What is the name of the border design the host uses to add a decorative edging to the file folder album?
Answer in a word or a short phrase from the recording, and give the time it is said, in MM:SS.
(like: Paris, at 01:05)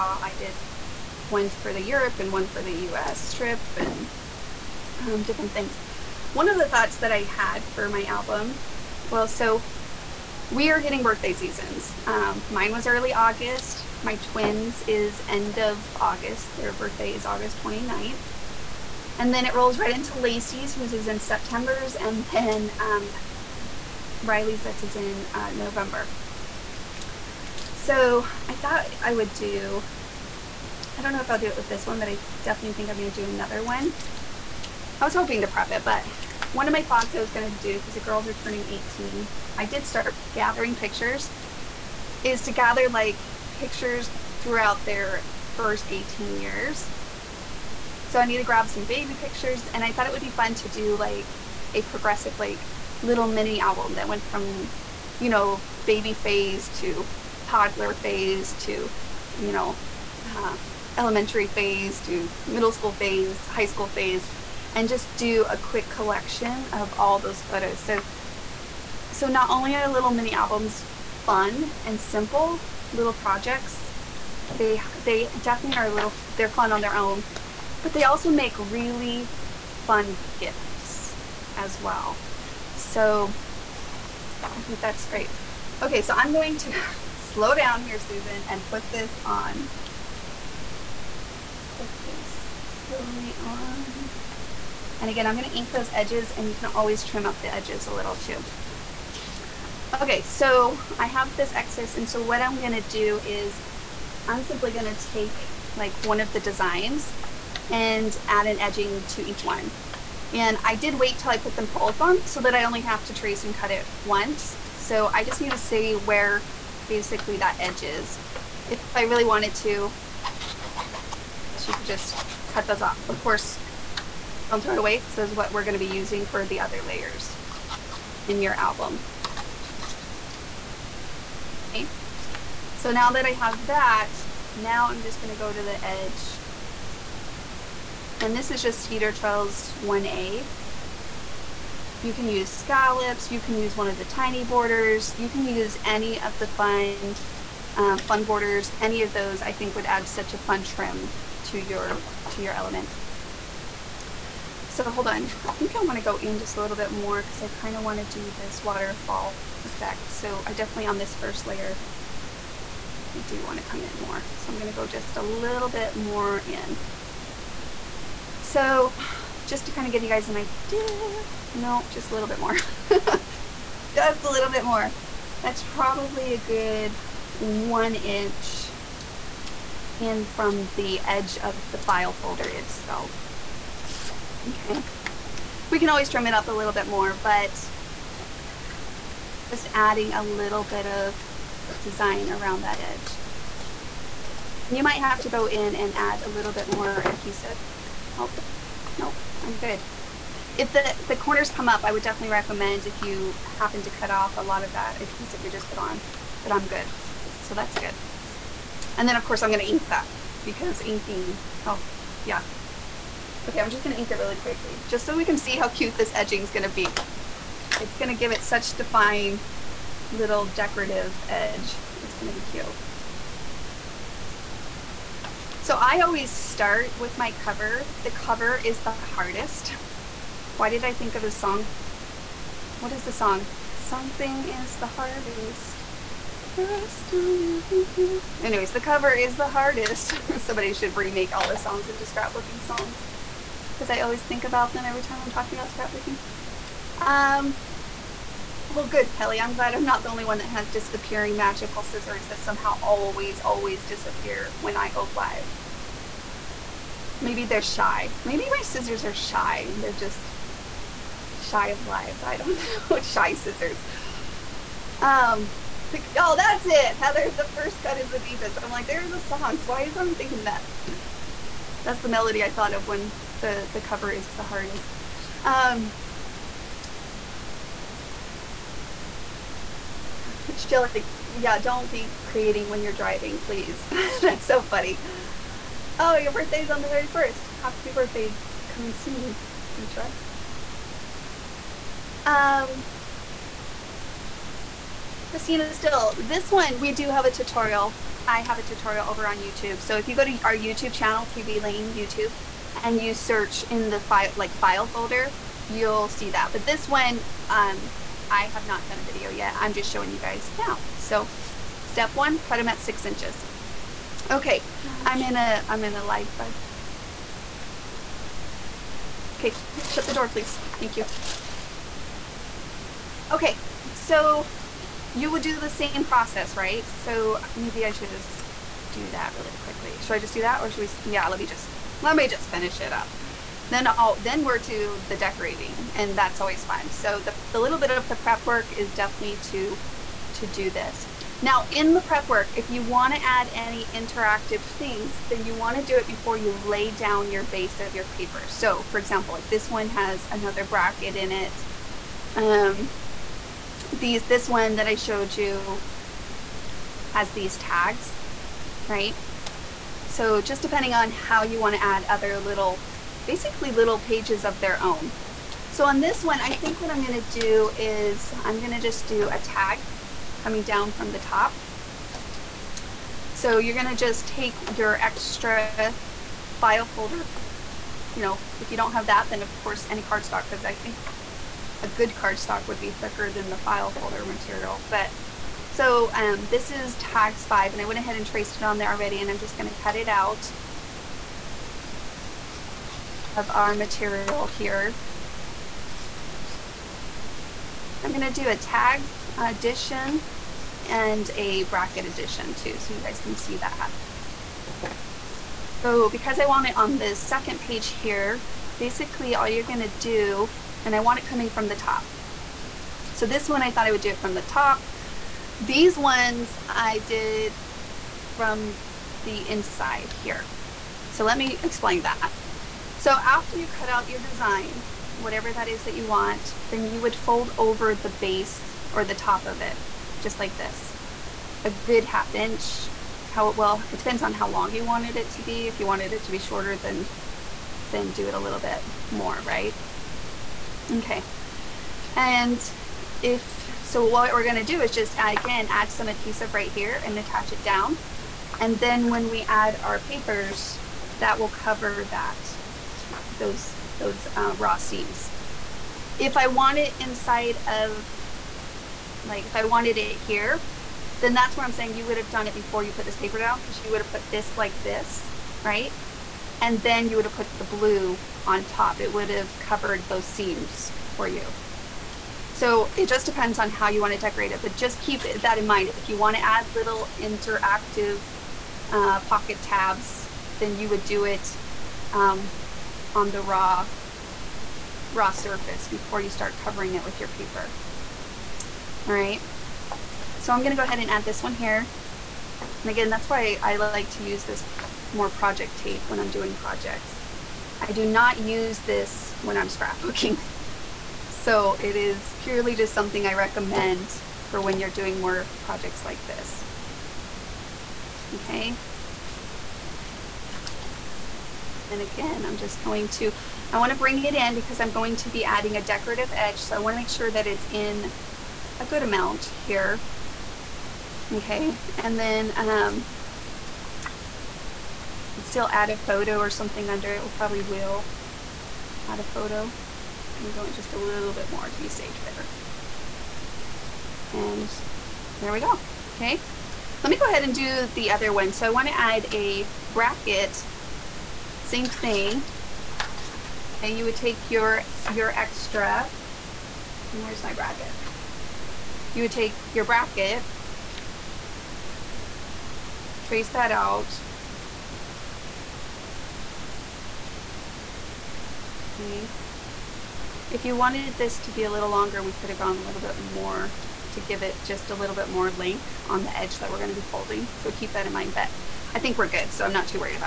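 Cedar Trails 1A, at 02:18.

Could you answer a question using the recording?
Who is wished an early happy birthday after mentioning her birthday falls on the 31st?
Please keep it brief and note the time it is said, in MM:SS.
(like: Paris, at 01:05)
Deetra, at 04:49.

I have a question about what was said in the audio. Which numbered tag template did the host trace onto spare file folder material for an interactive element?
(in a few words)
tags five.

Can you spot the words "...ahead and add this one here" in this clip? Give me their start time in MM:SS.
08:10.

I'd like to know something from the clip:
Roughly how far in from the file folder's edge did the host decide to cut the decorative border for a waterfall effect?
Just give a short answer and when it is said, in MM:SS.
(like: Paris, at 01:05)
1 inch, at 02:57.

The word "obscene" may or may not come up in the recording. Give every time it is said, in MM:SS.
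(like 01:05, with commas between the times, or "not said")
not said.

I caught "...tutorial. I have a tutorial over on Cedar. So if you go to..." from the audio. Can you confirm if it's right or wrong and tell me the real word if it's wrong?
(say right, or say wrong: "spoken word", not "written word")
wrong: "YouTube", not "Cedar".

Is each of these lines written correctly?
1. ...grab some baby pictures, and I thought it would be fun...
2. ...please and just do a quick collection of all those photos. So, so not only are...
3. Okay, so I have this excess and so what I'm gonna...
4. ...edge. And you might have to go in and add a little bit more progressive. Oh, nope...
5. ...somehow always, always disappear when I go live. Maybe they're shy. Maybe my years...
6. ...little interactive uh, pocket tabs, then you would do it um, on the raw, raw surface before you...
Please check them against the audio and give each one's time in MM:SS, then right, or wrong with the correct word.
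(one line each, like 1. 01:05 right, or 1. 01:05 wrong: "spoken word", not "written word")
1. 00:48 right
2. 01:03 wrong: "phase", not "please"
3. 01:40 right
4. 03:12 wrong: "adhesive", not "progressive"
5. 04:12 wrong: "scissors", not "years"
6. 07:56 right.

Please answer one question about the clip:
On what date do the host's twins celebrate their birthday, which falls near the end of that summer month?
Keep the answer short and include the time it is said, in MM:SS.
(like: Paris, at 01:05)
August 29th, at 00:17.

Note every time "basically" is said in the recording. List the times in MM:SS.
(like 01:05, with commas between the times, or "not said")
01:56, 06:03, 06:48.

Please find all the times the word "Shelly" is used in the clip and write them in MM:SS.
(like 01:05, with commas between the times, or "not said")
04:40.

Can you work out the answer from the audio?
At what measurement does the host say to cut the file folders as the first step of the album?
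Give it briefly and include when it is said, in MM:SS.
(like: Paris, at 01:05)
6 inches, at 05:12.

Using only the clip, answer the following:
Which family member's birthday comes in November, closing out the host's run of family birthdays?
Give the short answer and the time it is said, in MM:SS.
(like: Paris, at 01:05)
Riley, at 00:24.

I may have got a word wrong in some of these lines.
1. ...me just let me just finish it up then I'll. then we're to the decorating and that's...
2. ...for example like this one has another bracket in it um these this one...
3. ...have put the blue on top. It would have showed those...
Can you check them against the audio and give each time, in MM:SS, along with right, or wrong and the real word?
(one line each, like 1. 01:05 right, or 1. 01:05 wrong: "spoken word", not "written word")
1. 05:31 right
2. 05:48 right
3. 07:47 wrong: "covered", not "showed".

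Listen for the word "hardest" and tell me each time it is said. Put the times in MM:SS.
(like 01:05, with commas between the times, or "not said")
03:49, 03:54, 03:59, 04:34.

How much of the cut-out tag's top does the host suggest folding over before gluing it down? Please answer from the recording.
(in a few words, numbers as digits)
half inch.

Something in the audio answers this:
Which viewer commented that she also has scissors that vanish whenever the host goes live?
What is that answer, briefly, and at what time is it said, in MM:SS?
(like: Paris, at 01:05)
Kelly, at 04:09.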